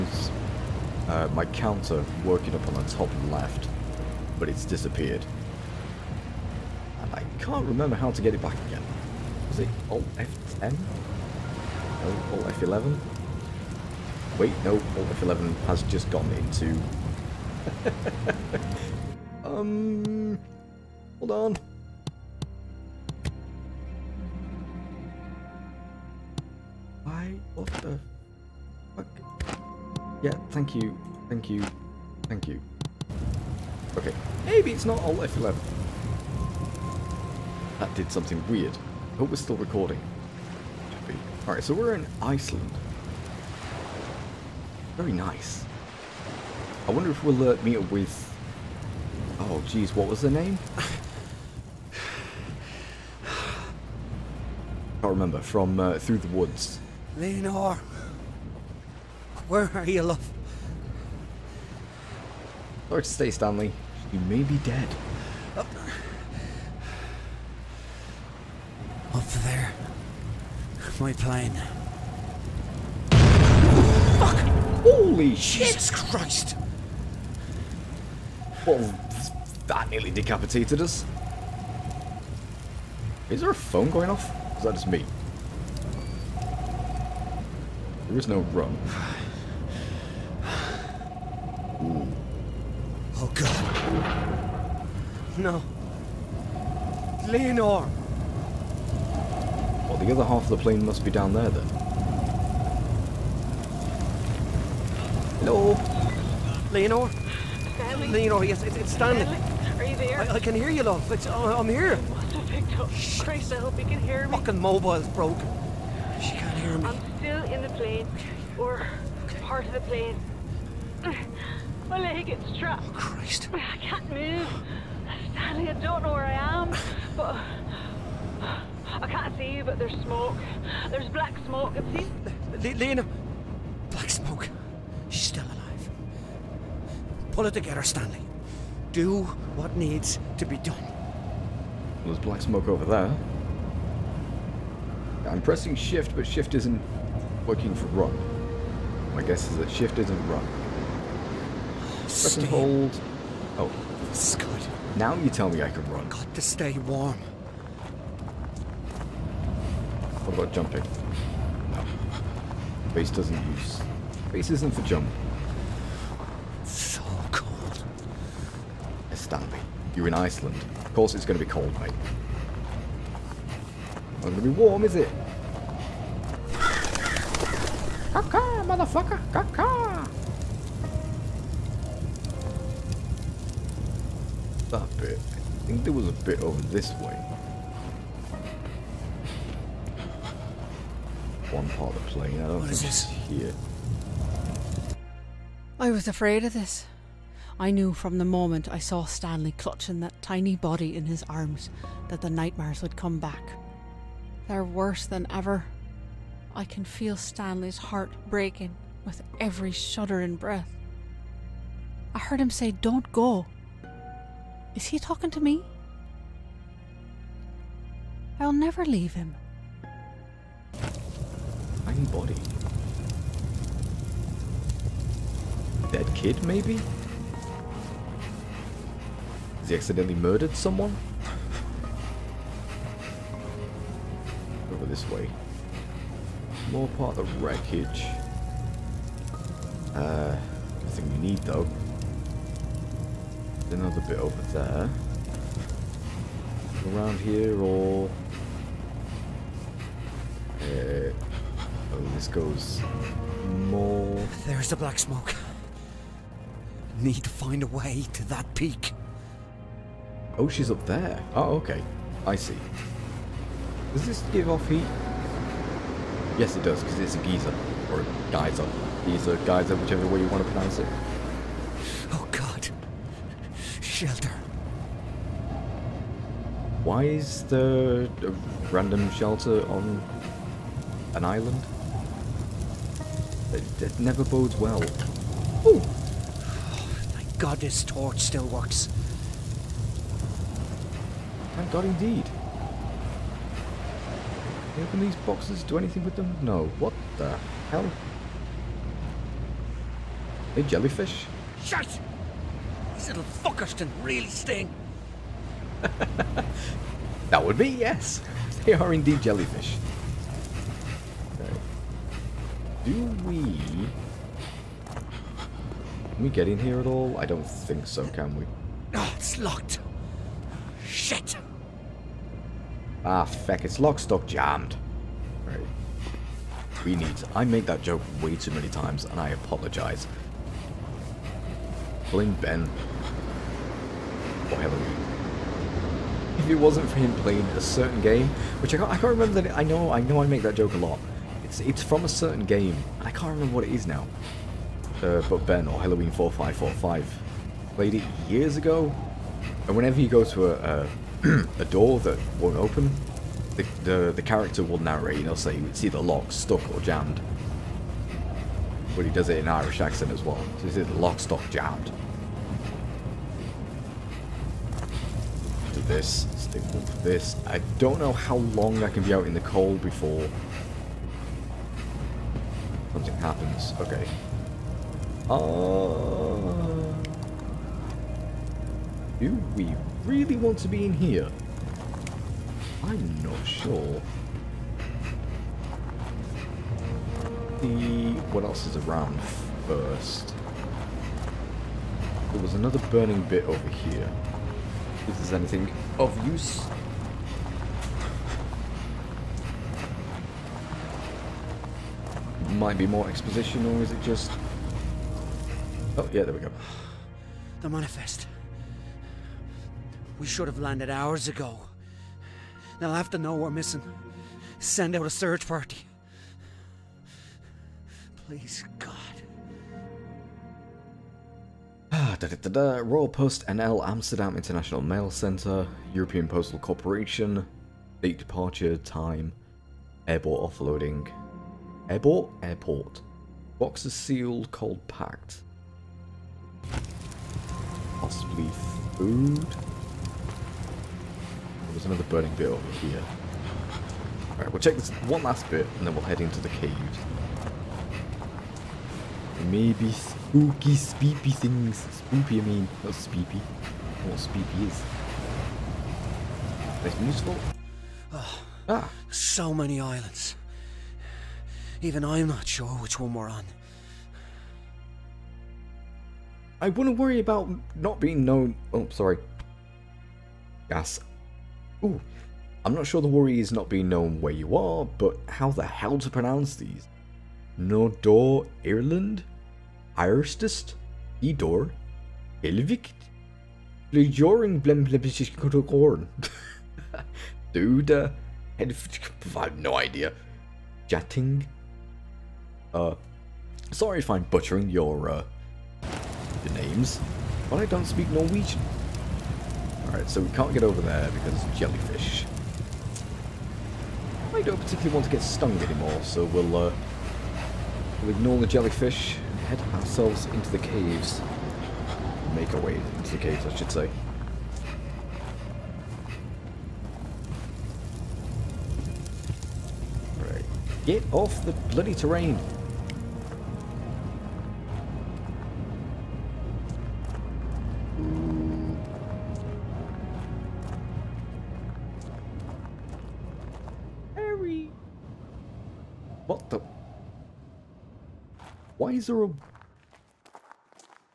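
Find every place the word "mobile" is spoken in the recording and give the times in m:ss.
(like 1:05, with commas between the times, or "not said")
1:54.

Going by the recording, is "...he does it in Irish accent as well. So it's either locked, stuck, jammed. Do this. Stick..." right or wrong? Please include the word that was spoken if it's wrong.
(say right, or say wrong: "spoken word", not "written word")
right.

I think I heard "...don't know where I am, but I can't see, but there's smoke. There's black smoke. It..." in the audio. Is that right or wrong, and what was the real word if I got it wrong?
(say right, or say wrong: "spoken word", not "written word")
right.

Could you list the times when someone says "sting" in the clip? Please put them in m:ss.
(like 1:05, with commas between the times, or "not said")
5:04.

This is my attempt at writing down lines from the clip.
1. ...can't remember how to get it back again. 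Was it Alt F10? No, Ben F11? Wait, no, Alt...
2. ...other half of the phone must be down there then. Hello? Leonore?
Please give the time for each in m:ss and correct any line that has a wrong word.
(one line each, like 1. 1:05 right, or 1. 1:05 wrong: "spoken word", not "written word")
1. 0:07 wrong: "Alt", not "Ben"
2. 1:40 wrong: "plane", not "phone".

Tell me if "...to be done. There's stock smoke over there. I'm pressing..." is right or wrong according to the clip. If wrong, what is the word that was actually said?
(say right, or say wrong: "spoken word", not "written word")
wrong: "black", not "stock".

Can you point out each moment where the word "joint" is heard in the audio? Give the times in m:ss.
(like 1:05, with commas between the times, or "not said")
not said.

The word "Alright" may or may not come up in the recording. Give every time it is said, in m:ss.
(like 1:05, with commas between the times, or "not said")
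0:41, 7:24, 8:19.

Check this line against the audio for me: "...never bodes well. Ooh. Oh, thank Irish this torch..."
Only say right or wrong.
wrong.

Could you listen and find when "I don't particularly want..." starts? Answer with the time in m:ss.
8:24.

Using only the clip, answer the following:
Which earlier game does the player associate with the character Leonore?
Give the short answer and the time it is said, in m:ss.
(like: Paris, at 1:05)
Through the Woods, at 0:55.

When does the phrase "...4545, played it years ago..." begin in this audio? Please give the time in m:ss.
5:46.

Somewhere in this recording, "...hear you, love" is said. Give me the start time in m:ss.
1:50.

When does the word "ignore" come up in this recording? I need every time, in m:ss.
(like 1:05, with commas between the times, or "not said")
8:28.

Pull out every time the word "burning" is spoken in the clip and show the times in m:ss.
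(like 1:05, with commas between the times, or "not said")
6:32, 7:22.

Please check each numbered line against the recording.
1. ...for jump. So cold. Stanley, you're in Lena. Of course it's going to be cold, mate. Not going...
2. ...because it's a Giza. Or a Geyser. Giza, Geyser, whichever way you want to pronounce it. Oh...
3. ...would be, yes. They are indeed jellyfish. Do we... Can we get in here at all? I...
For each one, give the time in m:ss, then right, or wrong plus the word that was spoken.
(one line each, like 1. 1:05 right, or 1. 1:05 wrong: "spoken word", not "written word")
1. 2:44 wrong: "Iceland", not "Lena"
2. 4:26 right
3. 5:07 right.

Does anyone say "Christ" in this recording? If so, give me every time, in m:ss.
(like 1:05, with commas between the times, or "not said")
1:15, 1:53, 2:02.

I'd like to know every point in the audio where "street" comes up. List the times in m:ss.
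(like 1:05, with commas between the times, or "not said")
not said.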